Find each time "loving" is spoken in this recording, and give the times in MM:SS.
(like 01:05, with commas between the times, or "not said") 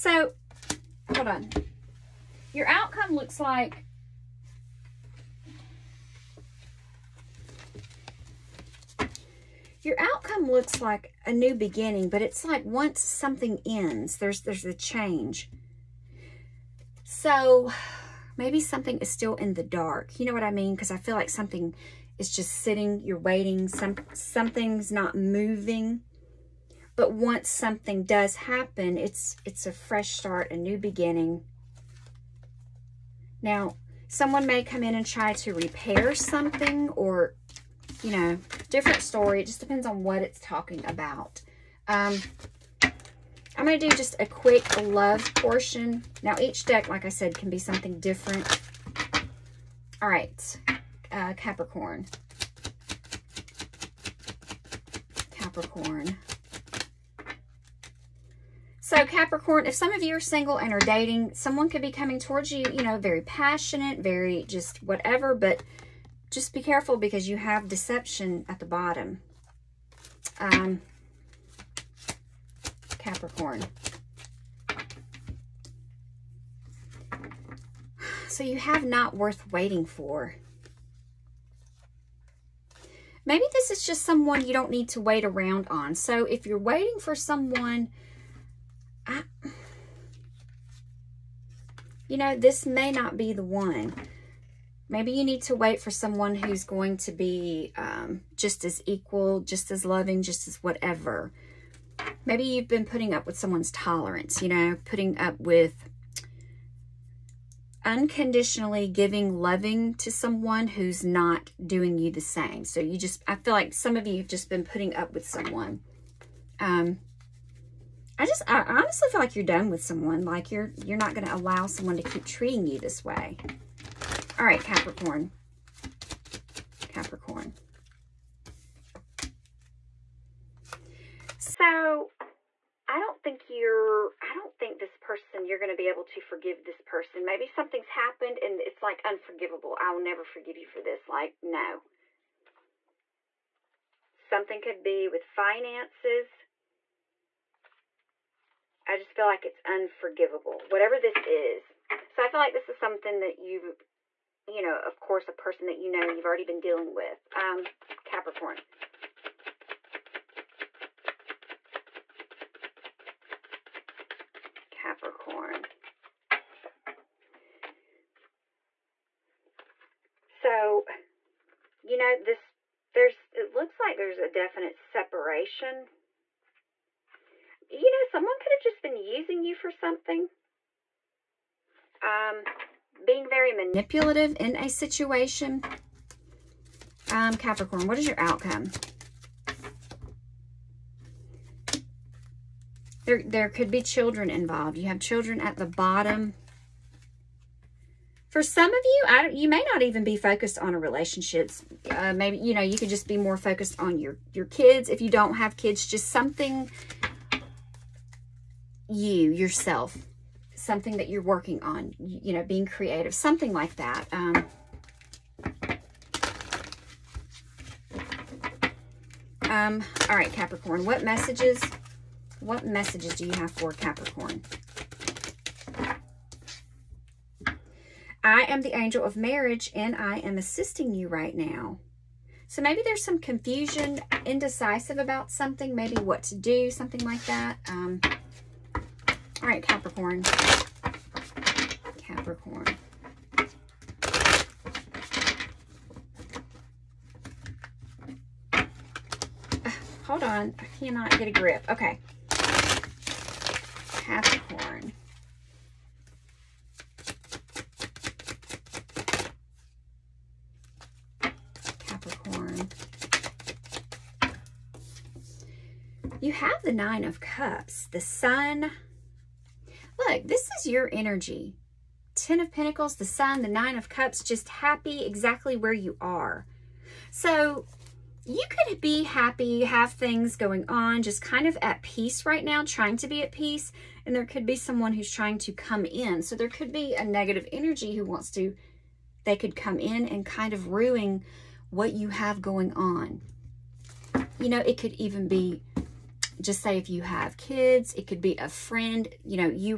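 01:39, 01:49.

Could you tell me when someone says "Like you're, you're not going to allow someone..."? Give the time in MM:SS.
02:00.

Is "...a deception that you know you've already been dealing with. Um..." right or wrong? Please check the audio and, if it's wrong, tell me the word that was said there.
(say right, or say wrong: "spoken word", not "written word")
wrong: "person", not "deception".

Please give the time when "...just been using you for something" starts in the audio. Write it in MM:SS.
02:58.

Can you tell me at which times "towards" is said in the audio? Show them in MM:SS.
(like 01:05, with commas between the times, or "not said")
01:02.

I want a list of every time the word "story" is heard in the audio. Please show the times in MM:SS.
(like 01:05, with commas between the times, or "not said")
00:39.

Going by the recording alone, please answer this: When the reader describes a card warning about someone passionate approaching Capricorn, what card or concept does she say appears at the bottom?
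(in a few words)
Deception.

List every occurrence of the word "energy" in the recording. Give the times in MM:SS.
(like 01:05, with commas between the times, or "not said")
04:30, 04:47.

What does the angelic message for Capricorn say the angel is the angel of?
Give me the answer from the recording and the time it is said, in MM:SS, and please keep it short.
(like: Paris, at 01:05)
Marriage, at 03:49.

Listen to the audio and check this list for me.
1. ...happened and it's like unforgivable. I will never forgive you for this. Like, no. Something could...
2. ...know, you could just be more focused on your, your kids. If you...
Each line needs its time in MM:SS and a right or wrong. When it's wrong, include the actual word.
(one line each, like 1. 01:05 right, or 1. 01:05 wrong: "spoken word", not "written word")
1. 02:17 right
2. 03:22 right.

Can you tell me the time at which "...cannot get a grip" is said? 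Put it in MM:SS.
04:10.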